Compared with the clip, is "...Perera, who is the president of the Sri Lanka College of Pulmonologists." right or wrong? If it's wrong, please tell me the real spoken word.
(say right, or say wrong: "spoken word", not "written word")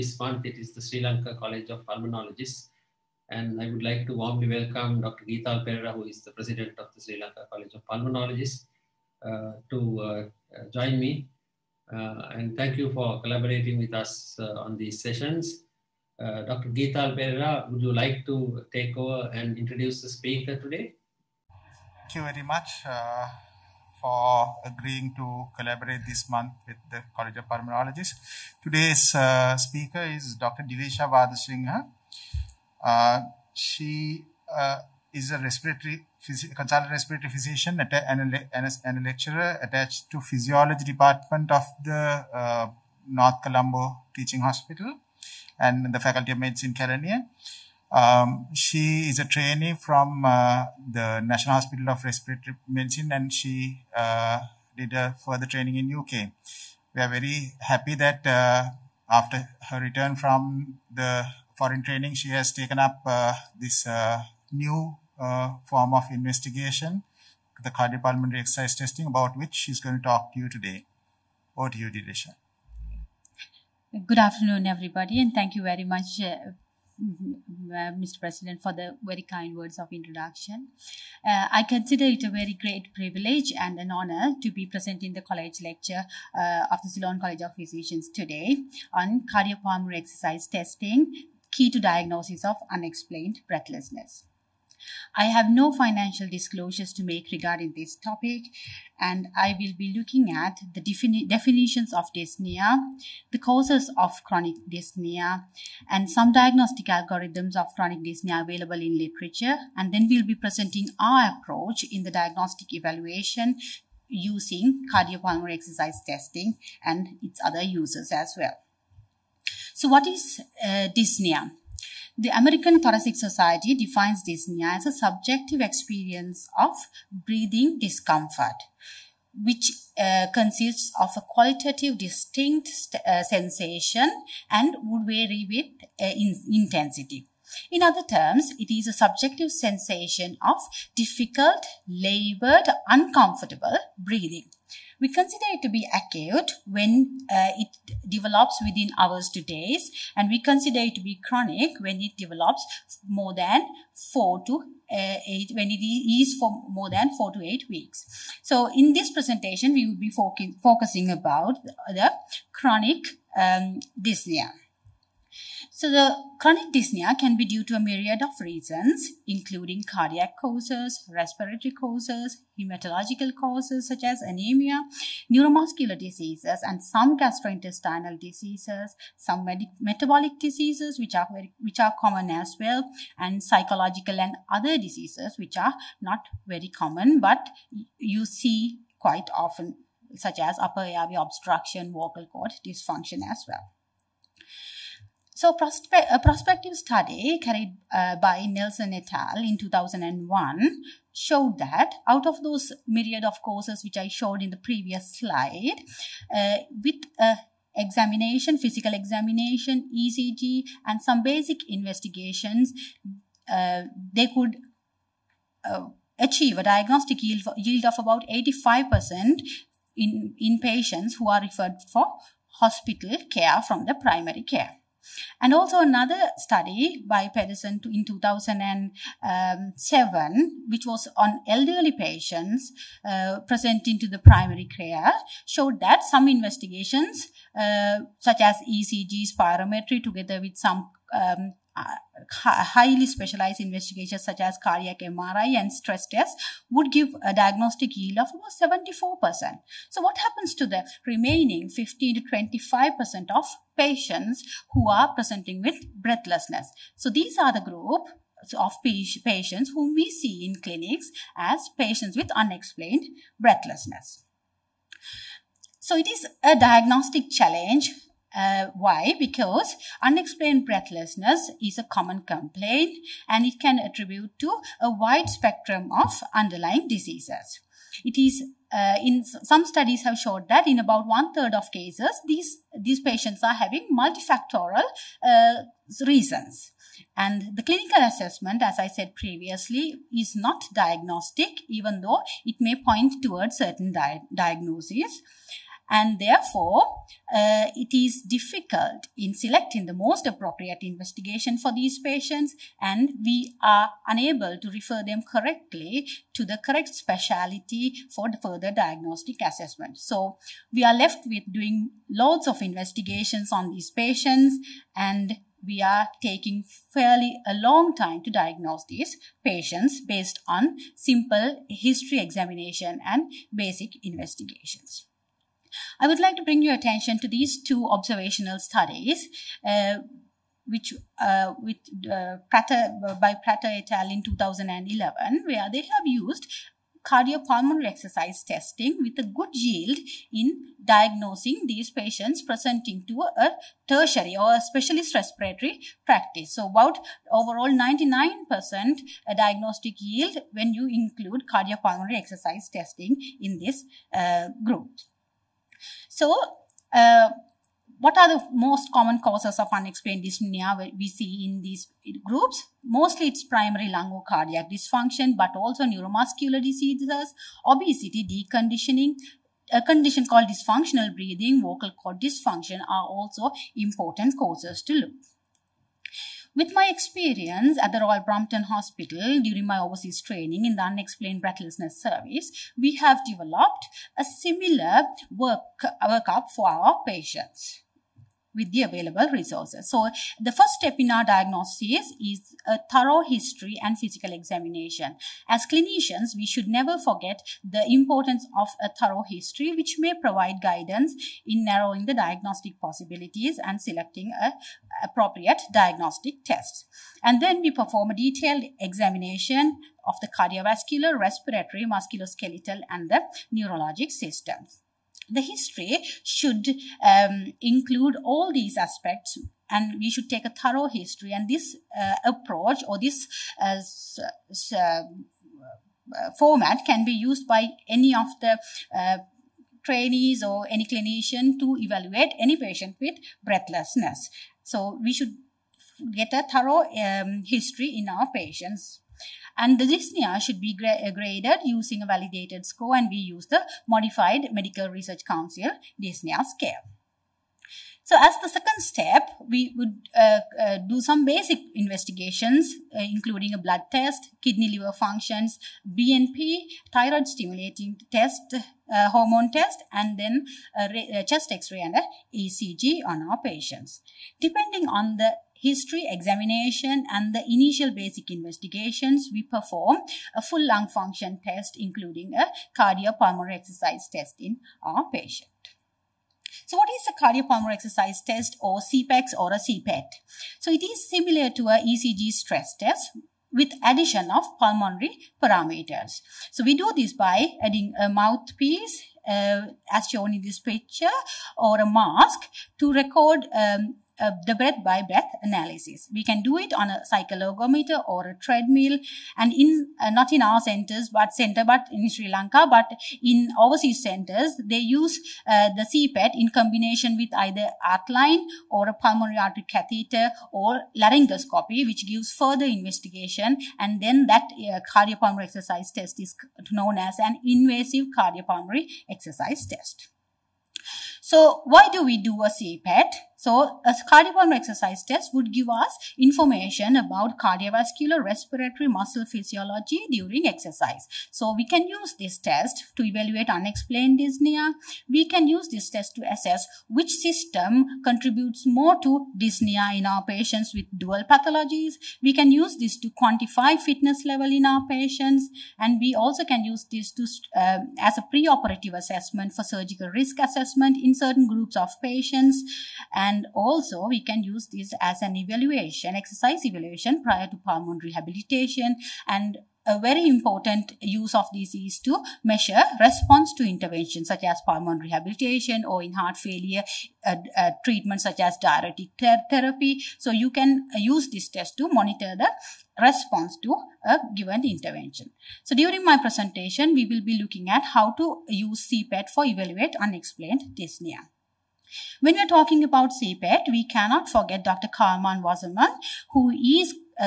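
right.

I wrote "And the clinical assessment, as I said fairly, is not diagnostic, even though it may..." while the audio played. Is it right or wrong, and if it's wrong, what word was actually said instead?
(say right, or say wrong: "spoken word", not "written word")
wrong: "previously", not "fairly".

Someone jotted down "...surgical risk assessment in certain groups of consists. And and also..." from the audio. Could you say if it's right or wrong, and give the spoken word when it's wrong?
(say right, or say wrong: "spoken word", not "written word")
wrong: "patients", not "consists".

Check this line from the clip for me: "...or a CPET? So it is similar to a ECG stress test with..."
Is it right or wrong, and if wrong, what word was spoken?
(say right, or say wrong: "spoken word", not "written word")
right.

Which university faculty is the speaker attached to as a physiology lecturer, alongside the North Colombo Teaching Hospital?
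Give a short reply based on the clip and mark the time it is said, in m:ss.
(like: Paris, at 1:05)
Faculty of Medicine Kelaniya, at 0:45.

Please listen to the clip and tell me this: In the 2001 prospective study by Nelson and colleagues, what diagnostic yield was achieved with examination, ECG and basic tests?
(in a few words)
85%.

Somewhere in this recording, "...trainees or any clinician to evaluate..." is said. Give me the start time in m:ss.
7:09.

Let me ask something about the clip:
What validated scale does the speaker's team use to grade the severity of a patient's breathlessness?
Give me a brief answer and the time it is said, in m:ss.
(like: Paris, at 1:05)
modified Medical Research Council dyspnea scale, at 7:23.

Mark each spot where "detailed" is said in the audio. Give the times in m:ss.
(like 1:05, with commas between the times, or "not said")
6:48.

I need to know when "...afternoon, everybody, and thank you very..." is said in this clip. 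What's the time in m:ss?
1:14.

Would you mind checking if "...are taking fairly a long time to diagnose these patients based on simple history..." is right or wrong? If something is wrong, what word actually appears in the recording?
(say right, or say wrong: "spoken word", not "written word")
right.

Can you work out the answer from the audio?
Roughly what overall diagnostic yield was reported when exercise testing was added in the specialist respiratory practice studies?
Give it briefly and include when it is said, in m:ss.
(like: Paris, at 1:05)
99%, at 5:47.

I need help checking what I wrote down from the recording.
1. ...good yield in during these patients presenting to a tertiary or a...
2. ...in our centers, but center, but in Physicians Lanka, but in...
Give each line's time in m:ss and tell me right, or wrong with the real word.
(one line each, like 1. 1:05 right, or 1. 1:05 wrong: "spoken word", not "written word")
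1. 5:39 wrong: "diagnosing", not "during"
2. 8:20 wrong: "Sri", not "Physicians".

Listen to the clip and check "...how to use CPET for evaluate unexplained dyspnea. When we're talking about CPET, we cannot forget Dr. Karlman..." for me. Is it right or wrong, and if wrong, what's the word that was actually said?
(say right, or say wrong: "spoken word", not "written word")
right.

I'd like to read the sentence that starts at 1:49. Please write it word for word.
And then we'll be presenting our approach in the diagnostic evaluation using cardiopulmonary exercise testing and its other uses as well.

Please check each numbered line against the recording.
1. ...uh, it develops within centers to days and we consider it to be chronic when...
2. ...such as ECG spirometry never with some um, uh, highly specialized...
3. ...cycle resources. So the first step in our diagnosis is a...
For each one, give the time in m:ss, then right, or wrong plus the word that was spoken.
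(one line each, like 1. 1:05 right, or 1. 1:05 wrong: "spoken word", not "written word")
1. 2:27 wrong: "hours", not "centers"
2. 3:58 wrong: "together", not "never"
3. 6:28 wrong: "available", not "cycle".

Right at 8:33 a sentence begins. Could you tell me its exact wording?
And then that uh, cardiopulmonary exercise test is known as an invasive cardiopulmonary exercise test.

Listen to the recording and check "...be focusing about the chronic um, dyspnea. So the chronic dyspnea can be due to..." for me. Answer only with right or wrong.
right.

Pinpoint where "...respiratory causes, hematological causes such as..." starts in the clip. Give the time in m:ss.
2:51.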